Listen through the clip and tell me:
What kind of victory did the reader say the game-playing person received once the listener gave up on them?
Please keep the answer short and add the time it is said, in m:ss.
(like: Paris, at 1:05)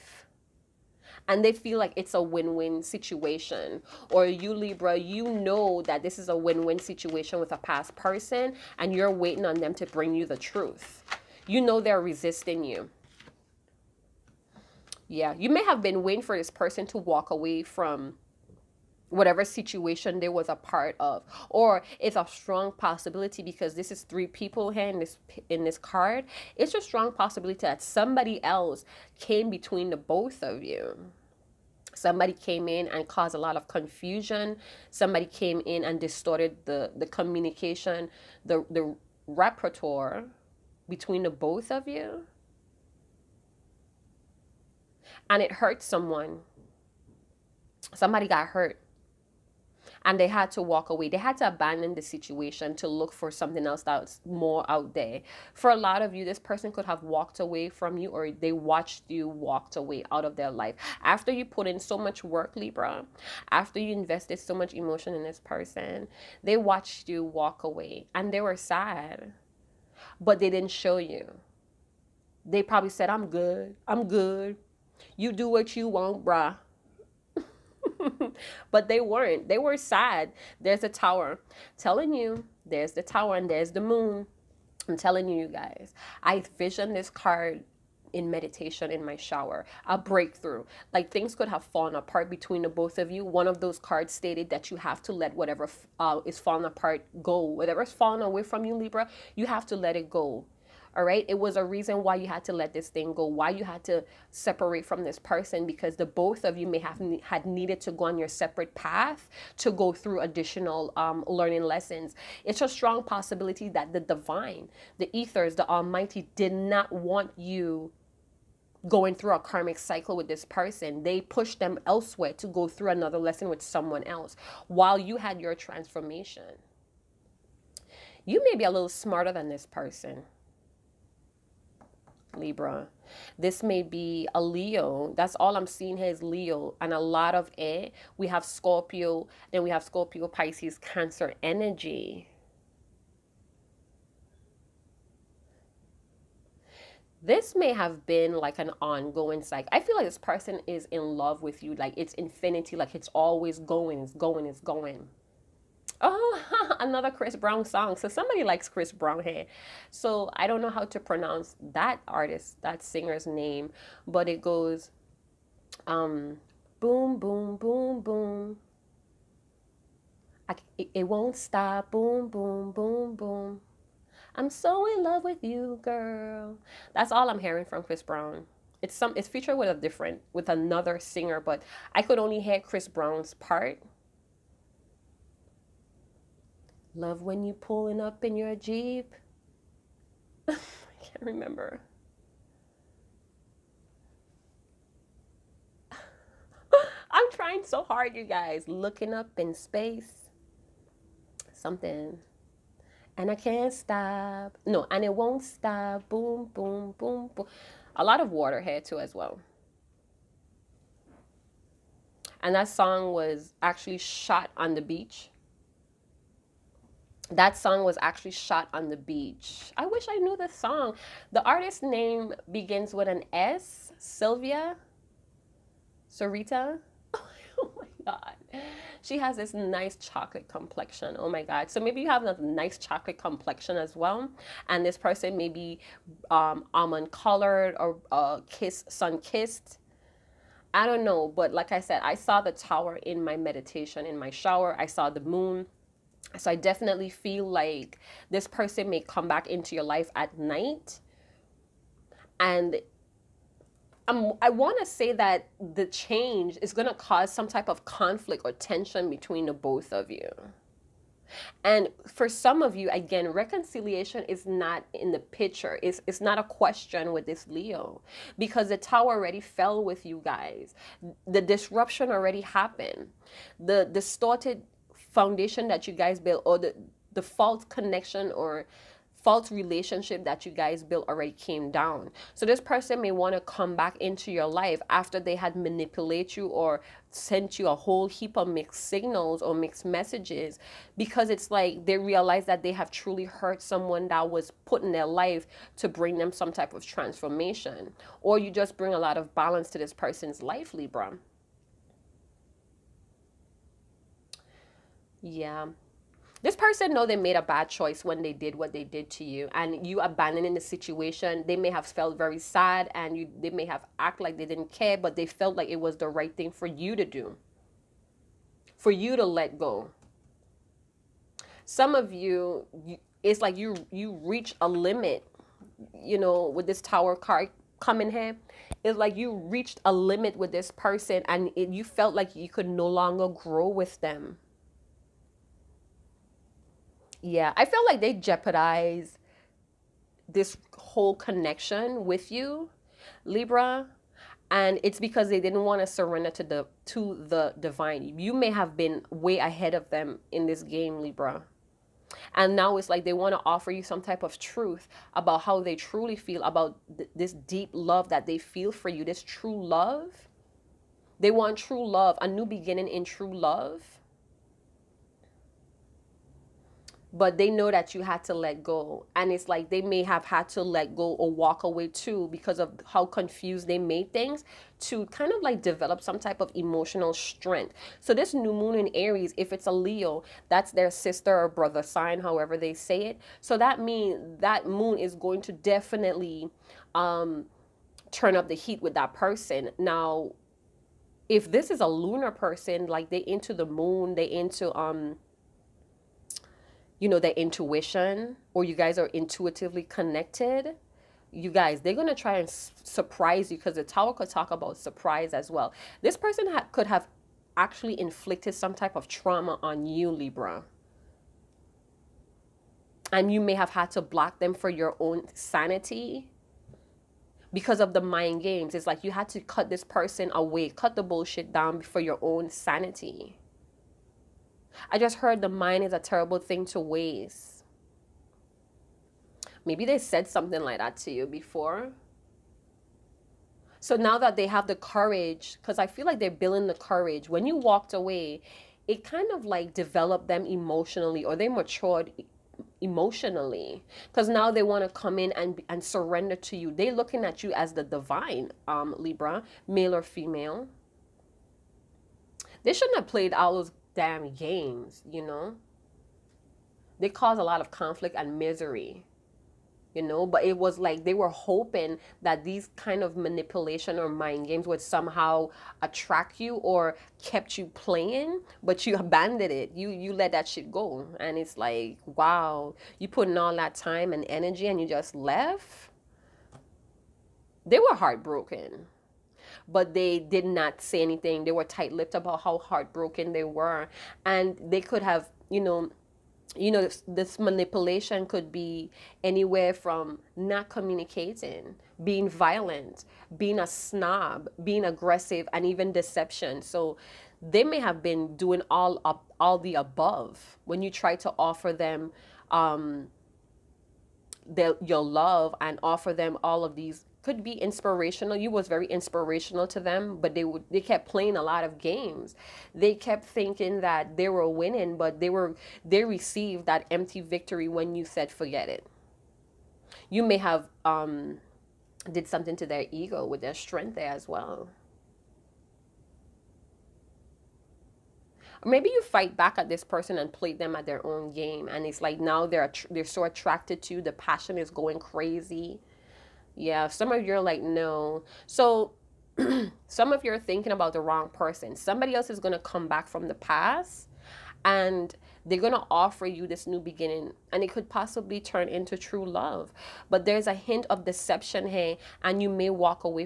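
Empty victory, at 8:36.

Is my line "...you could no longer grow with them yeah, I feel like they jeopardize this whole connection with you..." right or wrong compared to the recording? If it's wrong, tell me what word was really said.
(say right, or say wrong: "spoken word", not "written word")
right.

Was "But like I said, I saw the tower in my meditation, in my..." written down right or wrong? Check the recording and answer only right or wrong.
right.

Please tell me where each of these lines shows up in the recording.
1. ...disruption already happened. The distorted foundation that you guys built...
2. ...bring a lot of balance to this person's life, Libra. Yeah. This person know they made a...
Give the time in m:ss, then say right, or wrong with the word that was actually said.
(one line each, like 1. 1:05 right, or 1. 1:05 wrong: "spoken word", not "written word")
1. 4:31 right
2. 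4:58 right.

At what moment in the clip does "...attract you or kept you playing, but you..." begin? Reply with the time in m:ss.
7:45.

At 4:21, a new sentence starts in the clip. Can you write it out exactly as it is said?
And for some of you, again, reconciliation is not in the picture.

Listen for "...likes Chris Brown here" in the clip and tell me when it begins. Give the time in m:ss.
2:38.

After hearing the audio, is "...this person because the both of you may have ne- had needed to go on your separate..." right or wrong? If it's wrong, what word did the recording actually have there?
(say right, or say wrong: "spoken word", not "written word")
right.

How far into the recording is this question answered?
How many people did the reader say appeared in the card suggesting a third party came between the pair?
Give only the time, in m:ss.
0:24.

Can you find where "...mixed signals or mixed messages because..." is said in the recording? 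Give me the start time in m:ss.
4:48.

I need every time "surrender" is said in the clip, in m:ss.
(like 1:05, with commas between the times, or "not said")
5:45, 7:25.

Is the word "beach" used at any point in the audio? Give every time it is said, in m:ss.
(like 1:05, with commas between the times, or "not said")
3:34, 3:38.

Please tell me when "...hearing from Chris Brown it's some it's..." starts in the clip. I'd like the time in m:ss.
2:57.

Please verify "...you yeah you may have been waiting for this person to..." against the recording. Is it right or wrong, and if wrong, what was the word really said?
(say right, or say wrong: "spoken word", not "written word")
right.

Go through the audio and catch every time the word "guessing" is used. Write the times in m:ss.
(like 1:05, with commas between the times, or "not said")
not said.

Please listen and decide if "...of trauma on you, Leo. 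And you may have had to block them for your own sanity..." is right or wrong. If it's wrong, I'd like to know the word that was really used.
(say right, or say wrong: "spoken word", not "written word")
wrong: "Libra", not "Leo".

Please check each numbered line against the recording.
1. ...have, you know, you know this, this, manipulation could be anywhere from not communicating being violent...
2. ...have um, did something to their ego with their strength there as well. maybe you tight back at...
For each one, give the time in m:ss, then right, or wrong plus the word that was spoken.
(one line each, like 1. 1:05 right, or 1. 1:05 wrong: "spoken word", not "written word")
1. 8:05 right
2. 8:40 wrong: "fight", not "tight".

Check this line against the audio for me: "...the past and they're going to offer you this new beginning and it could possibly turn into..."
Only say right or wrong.
right.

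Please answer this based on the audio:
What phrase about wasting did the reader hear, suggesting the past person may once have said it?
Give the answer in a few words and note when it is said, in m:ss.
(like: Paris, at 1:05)
The mind is a terrible thing to waste, at 7:05.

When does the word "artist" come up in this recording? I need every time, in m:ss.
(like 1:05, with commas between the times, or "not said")
2:42, 3:41.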